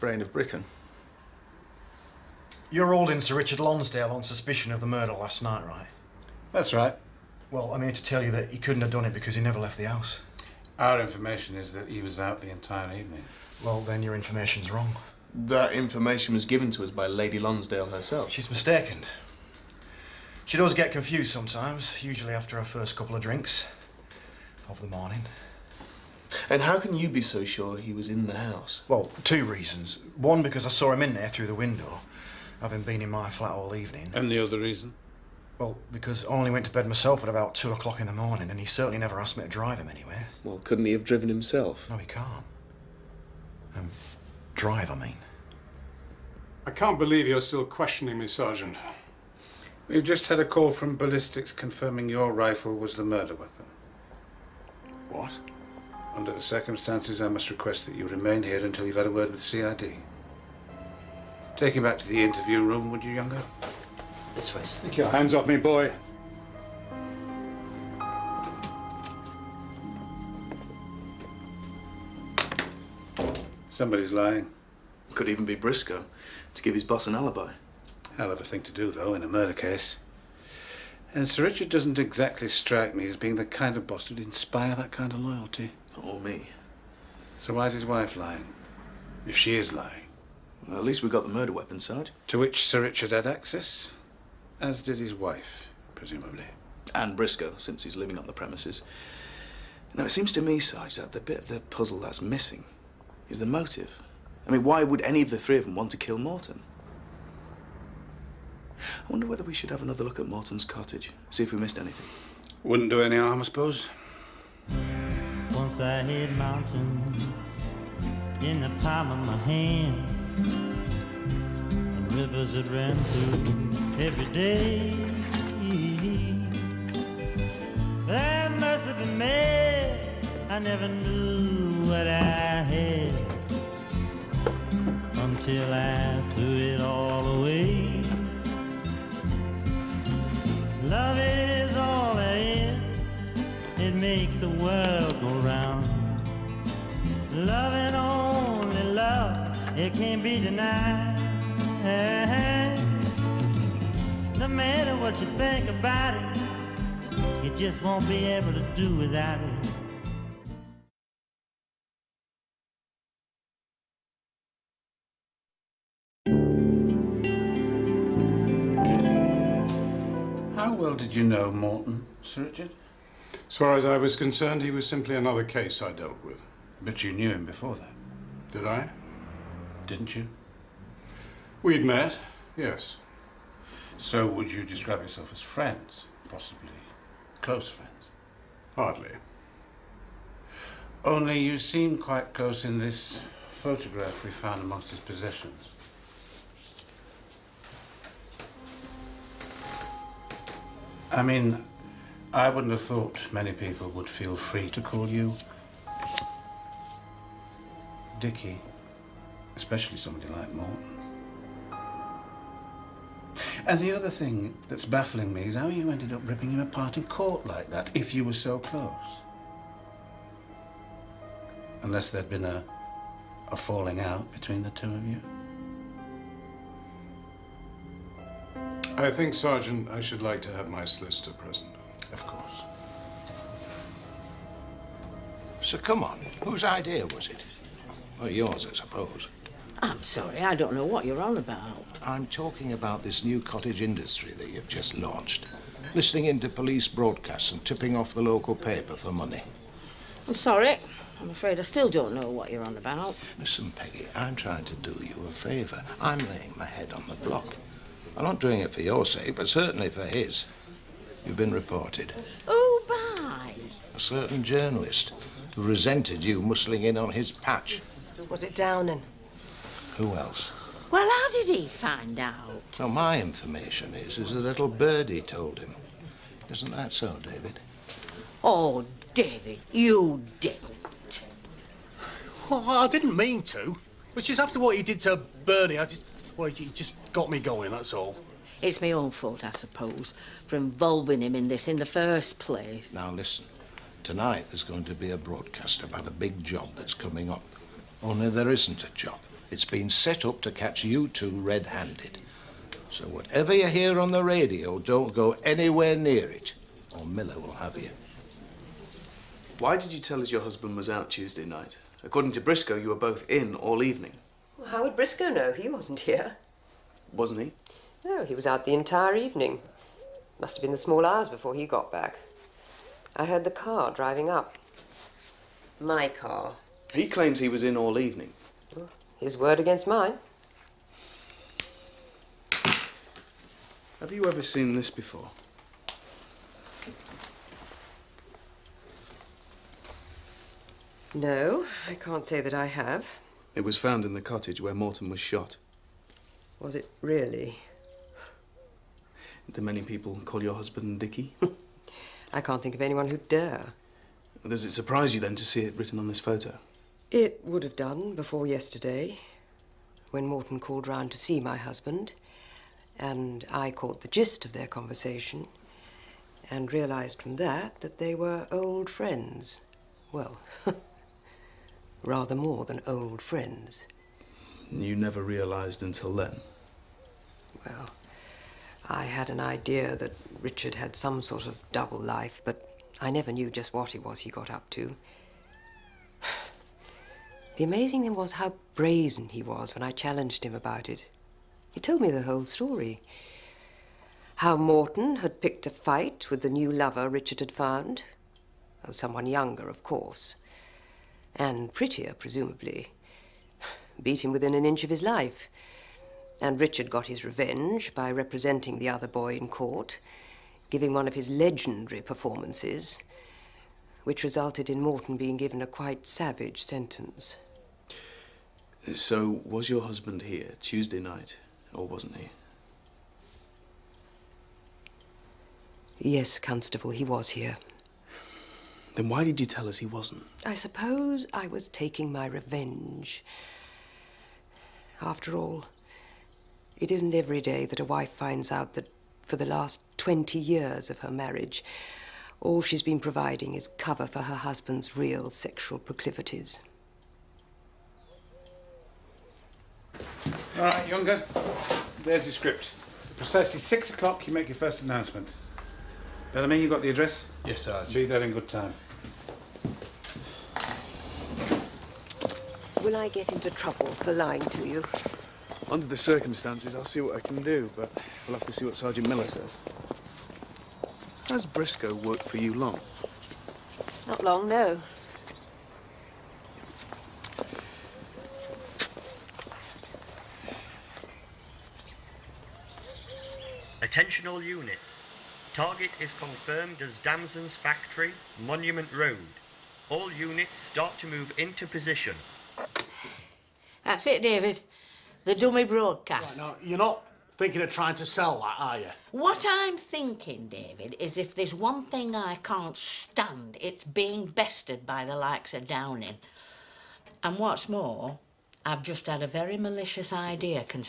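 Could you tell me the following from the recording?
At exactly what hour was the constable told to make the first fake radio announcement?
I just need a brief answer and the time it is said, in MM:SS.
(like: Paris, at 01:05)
6 o'clock, at 07:33.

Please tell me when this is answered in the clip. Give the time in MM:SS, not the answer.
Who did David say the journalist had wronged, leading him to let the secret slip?
04:45.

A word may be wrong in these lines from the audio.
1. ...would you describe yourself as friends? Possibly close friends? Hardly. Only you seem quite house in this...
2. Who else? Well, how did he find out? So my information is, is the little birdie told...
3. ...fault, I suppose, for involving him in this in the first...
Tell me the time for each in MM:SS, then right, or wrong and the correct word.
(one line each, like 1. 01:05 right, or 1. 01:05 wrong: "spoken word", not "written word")
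1. 03:04 wrong: "close", not "house"
2. 04:29 right
3. 04:49 right.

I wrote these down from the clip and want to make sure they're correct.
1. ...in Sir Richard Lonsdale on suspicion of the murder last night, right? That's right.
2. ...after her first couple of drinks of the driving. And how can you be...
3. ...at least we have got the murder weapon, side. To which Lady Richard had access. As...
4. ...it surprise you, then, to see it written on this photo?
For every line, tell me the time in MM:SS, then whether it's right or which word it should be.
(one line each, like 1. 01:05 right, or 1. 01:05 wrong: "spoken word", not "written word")
1. 00:03 right
2. 00:22 wrong: "morning", not "driving"
3. 01:30 wrong: "Sir", not "Lady"
4. 05:54 right.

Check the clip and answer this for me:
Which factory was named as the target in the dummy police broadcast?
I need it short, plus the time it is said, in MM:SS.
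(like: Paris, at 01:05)
Damson's Factory, at 08:06.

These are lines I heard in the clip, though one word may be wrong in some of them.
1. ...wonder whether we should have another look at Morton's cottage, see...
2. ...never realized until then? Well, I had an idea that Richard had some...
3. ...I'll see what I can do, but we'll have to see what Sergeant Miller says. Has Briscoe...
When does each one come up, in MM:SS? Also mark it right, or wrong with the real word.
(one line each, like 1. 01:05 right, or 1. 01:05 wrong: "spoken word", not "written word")
1. 01:49 right
2. 06:14 right
3. 07:46 right.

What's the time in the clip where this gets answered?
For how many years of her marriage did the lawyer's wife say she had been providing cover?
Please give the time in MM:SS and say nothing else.
07:19.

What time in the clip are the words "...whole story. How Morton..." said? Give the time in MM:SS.
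06:32.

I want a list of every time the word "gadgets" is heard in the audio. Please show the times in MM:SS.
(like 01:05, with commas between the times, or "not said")
not said.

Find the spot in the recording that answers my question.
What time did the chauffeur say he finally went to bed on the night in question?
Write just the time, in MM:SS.
00:37.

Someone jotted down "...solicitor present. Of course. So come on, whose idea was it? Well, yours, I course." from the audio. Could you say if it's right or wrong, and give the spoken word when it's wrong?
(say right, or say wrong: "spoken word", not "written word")
wrong: "suppose", not "course".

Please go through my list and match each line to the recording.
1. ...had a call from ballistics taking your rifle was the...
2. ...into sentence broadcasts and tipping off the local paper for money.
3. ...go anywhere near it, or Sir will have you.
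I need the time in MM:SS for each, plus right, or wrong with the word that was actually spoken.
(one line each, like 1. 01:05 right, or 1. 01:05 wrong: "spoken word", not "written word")
1. 00:50 wrong: "confirming", not "taking"
2. 04:06 wrong: "police", not "sentence"
3. 05:05 wrong: "Miller", not "Sir".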